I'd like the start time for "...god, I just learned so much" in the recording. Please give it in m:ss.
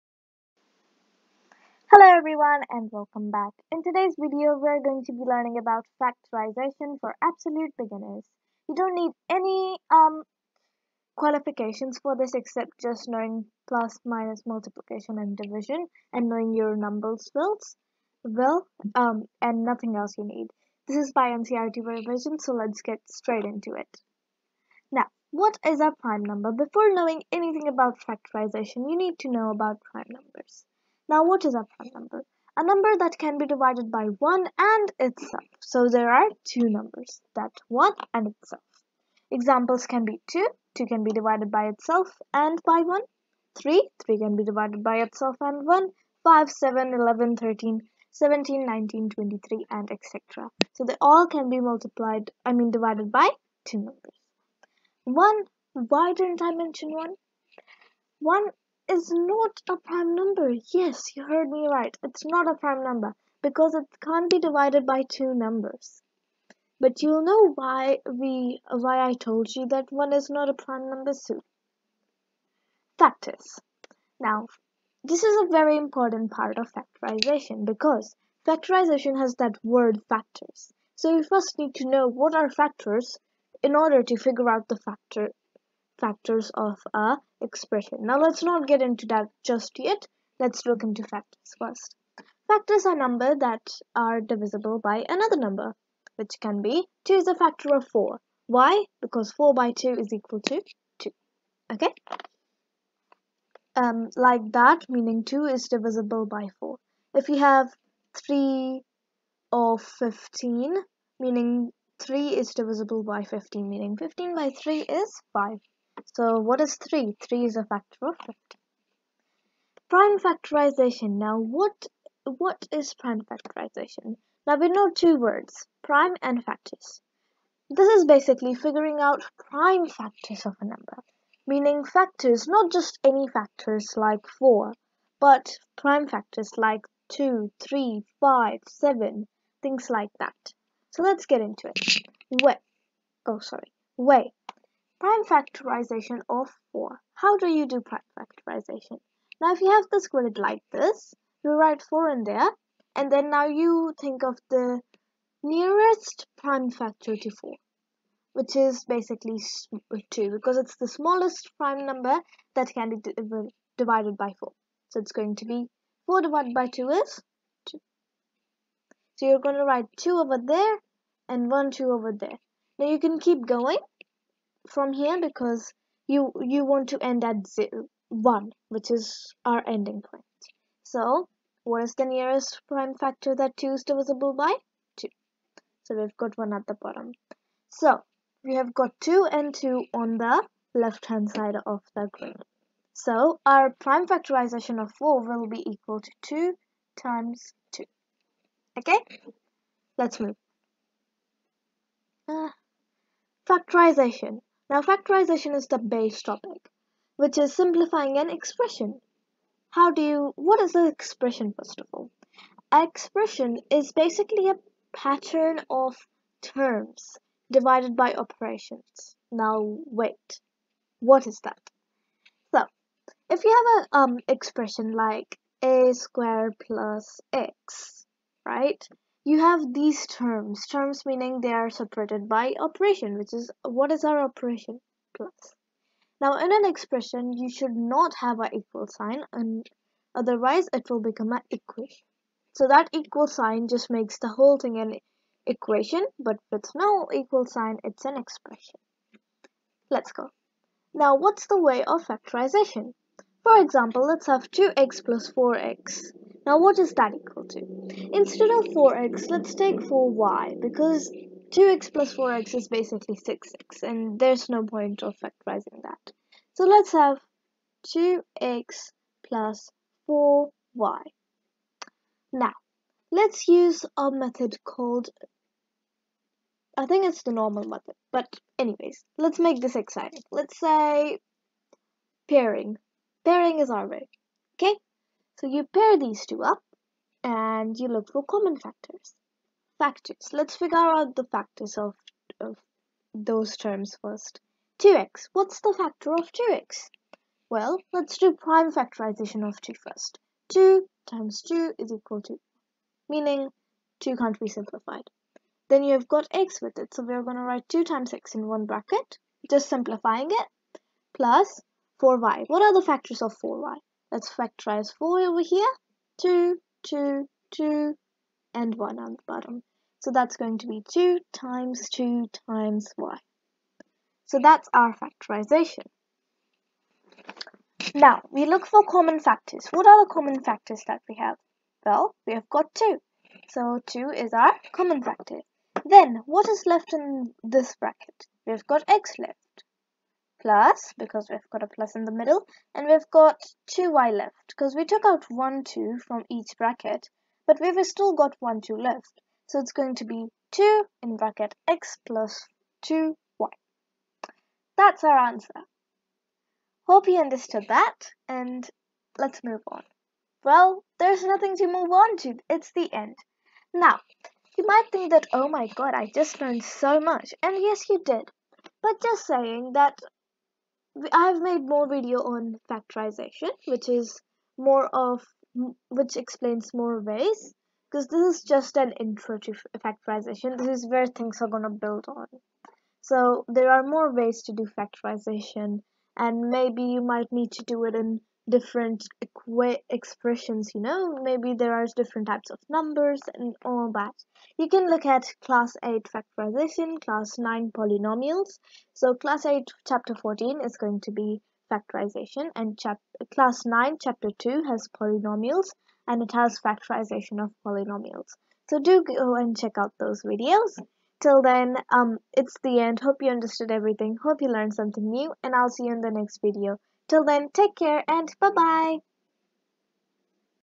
6:05.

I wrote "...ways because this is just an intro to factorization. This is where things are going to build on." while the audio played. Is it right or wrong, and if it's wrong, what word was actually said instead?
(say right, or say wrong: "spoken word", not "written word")
right.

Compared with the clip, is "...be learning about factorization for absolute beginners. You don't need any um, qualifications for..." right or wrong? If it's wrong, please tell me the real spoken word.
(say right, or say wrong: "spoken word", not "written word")
right.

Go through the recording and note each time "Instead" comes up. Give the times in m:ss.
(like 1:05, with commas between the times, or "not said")
4:18.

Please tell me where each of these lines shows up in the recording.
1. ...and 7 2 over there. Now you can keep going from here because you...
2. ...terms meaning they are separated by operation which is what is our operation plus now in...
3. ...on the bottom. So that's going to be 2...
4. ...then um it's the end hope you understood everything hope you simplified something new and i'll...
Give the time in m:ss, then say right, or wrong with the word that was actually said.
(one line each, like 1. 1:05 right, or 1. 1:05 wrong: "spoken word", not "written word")
1. 2:51 wrong: "1", not "7"
2. 3:50 right
3. 5:18 right
4. 6:51 wrong: "learned", not "simplified".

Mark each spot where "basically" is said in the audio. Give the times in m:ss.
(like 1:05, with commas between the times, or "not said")
2:08, 2:38, 3:33, 4:22.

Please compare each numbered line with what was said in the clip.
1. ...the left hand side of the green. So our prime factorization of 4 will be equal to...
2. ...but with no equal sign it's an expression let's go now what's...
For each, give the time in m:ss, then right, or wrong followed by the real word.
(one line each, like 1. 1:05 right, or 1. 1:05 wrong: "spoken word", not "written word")
1. 3:10 right
2. 4:06 right.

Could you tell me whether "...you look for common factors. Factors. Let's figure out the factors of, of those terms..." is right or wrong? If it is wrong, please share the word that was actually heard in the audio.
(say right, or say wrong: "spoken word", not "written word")
right.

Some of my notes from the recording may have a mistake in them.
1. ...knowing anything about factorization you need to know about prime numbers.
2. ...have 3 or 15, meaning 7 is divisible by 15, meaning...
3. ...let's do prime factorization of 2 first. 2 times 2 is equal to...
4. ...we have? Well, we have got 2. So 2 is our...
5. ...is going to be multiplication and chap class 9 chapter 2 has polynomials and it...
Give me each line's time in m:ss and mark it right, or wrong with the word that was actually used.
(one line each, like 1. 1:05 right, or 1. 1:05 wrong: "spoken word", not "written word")
1. 0:26 right
2. 1:47 wrong: "3", not "7"
3. 4:57 right
4. 5:31 right
5. 6:40 wrong: "factorization", not "multiplication".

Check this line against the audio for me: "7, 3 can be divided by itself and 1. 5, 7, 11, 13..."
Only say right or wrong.
wrong.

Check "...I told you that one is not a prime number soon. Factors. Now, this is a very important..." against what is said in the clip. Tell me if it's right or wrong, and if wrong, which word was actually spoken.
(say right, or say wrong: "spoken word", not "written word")
right.